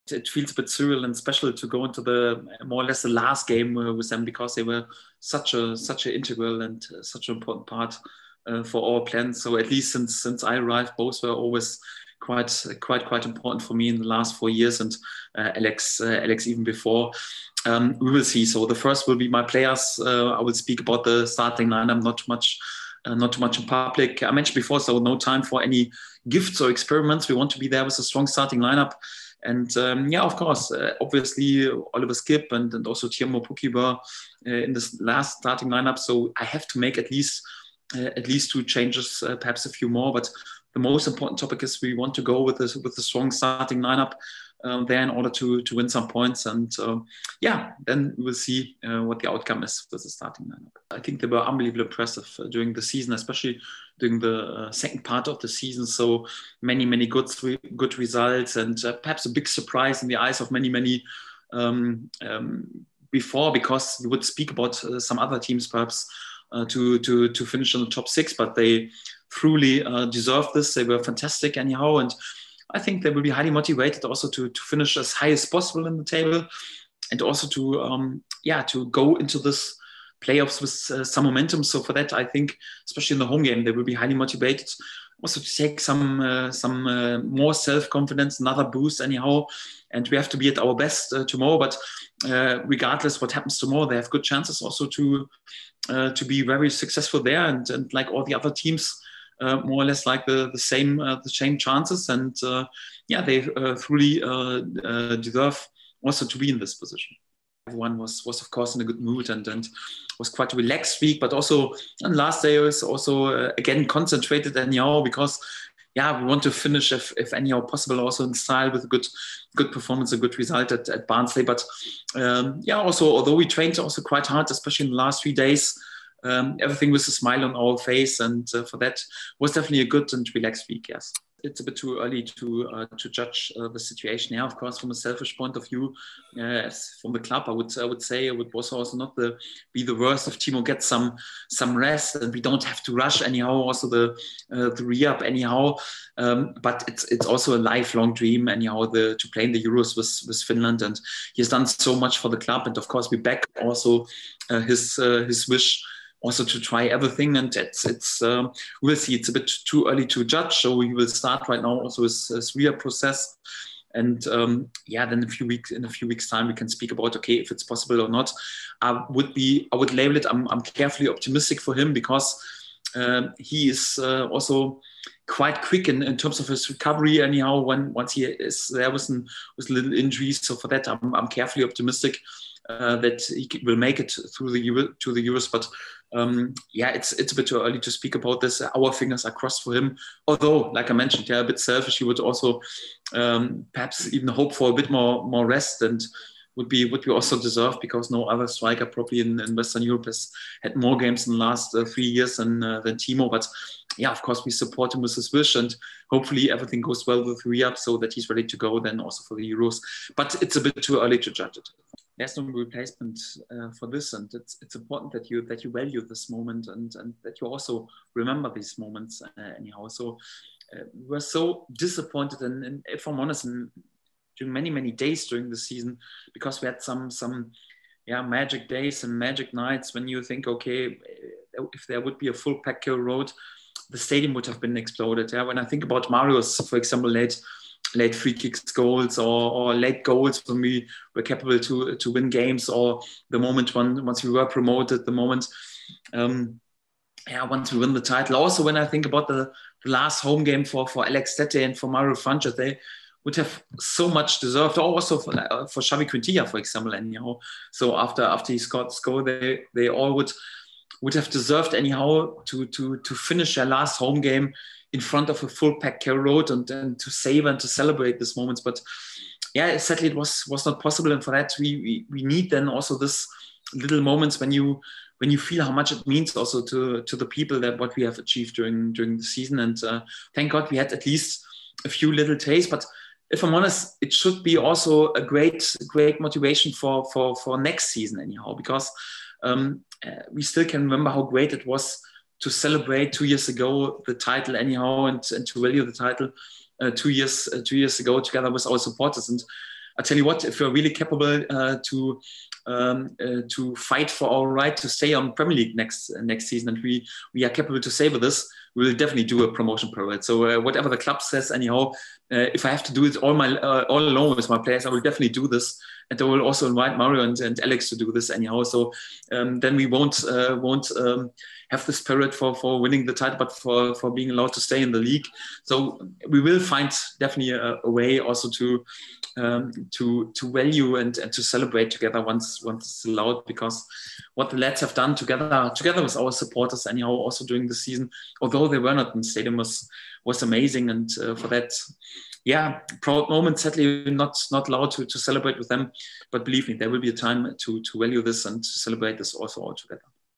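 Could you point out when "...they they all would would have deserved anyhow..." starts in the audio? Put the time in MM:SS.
04:19.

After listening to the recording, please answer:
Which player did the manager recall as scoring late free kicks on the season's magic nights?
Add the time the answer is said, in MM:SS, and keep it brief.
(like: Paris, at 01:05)
Marius, at 03:56.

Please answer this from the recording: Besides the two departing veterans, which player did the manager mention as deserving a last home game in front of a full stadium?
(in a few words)
Xavi Quintilla.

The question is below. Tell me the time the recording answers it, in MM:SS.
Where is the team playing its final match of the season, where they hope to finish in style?
02:01.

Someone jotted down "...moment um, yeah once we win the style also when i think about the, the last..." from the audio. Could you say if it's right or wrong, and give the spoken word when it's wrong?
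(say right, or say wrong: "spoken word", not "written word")
wrong: "title", not "style".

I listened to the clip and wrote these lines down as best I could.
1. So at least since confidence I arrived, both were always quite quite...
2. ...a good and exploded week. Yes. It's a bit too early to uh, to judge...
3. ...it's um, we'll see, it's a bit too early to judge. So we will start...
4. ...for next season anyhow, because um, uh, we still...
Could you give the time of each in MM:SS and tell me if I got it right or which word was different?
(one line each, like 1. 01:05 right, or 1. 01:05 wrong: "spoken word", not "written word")
1. 00:09 wrong: "since", not "confidence"
2. 02:09 wrong: "relaxed", not "exploded"
3. 02:37 right
4. 04:47 right.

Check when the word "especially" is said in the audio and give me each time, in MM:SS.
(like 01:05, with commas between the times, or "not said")
00:53, 01:22, 02:04.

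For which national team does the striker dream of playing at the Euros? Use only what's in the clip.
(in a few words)
Finland.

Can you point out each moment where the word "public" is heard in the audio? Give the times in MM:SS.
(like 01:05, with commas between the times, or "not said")
00:23.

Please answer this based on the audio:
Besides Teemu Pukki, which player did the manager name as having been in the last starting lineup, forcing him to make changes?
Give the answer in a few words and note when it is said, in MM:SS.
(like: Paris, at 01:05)
Oliver Skipp, at 00:31.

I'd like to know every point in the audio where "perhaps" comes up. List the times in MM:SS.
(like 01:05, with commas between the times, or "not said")
00:39, 00:58, 01:05, 03:13.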